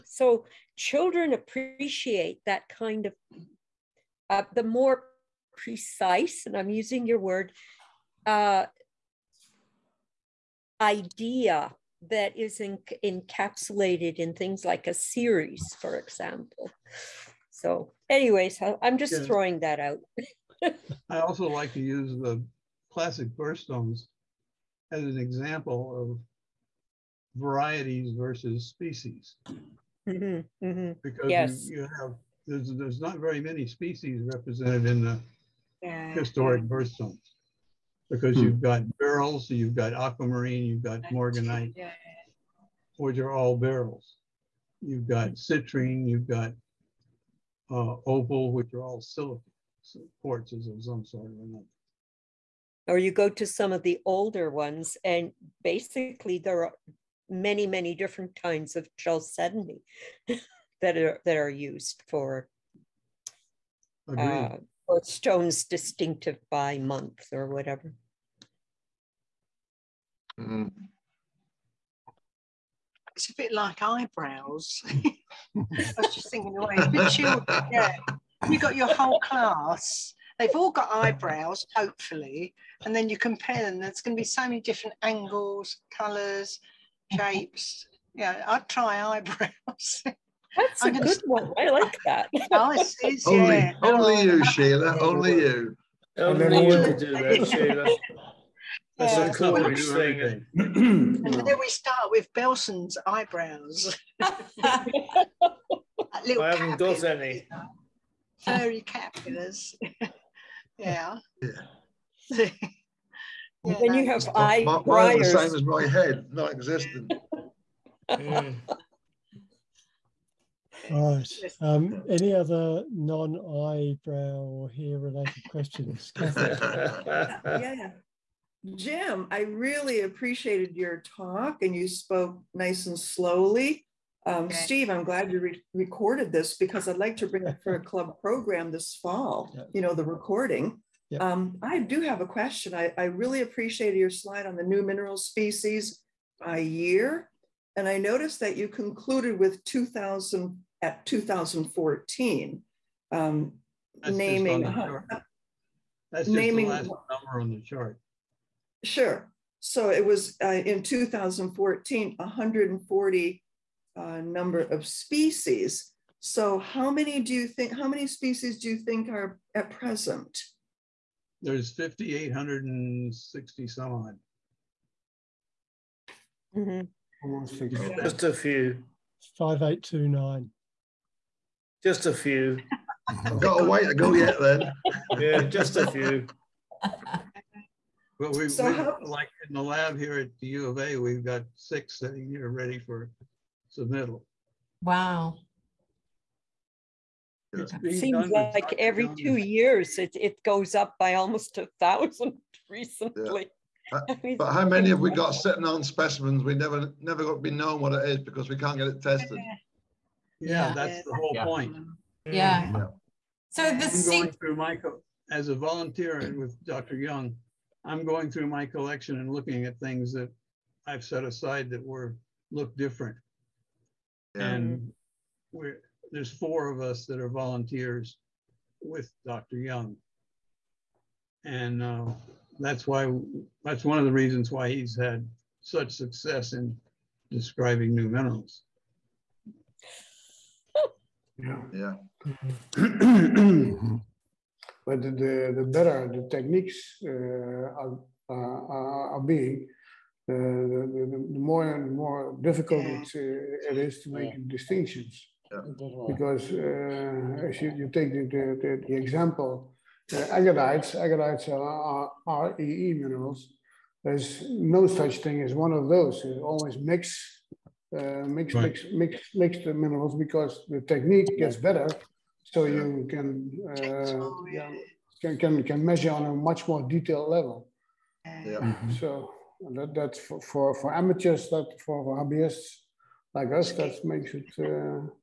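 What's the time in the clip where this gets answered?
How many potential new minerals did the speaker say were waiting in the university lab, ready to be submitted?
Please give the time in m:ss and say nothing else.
3:11.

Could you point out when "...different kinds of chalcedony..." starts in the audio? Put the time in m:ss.
0:57.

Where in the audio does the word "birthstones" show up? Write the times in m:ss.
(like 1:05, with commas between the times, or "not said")
0:23, 0:36.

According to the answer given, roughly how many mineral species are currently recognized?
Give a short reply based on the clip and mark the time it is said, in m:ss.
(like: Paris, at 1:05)
5829, at 2:59.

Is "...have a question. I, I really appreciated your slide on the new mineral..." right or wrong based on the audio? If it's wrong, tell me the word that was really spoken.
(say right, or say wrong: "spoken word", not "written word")
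right.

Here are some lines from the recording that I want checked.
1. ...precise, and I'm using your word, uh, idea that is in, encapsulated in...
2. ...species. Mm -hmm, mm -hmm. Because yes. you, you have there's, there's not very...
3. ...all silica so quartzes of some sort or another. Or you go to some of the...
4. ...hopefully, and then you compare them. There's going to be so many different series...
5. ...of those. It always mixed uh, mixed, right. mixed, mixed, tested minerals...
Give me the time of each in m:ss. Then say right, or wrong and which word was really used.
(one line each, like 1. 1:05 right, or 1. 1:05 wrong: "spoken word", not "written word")
1. 0:05 right
2. 0:28 right
3. 0:48 right
4. 1:21 wrong: "angles", not "series"
5. 4:25 wrong: "mixed", not "tested".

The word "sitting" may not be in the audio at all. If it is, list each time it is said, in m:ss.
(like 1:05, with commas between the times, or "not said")
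3:12, 3:25.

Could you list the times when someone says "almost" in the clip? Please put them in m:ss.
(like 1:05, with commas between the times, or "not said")
2:57, 3:21.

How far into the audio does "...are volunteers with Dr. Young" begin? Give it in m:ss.
3:47.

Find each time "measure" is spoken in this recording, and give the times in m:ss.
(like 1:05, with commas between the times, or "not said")
4:35.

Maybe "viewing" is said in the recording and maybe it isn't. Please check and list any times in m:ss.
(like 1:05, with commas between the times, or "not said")
not said.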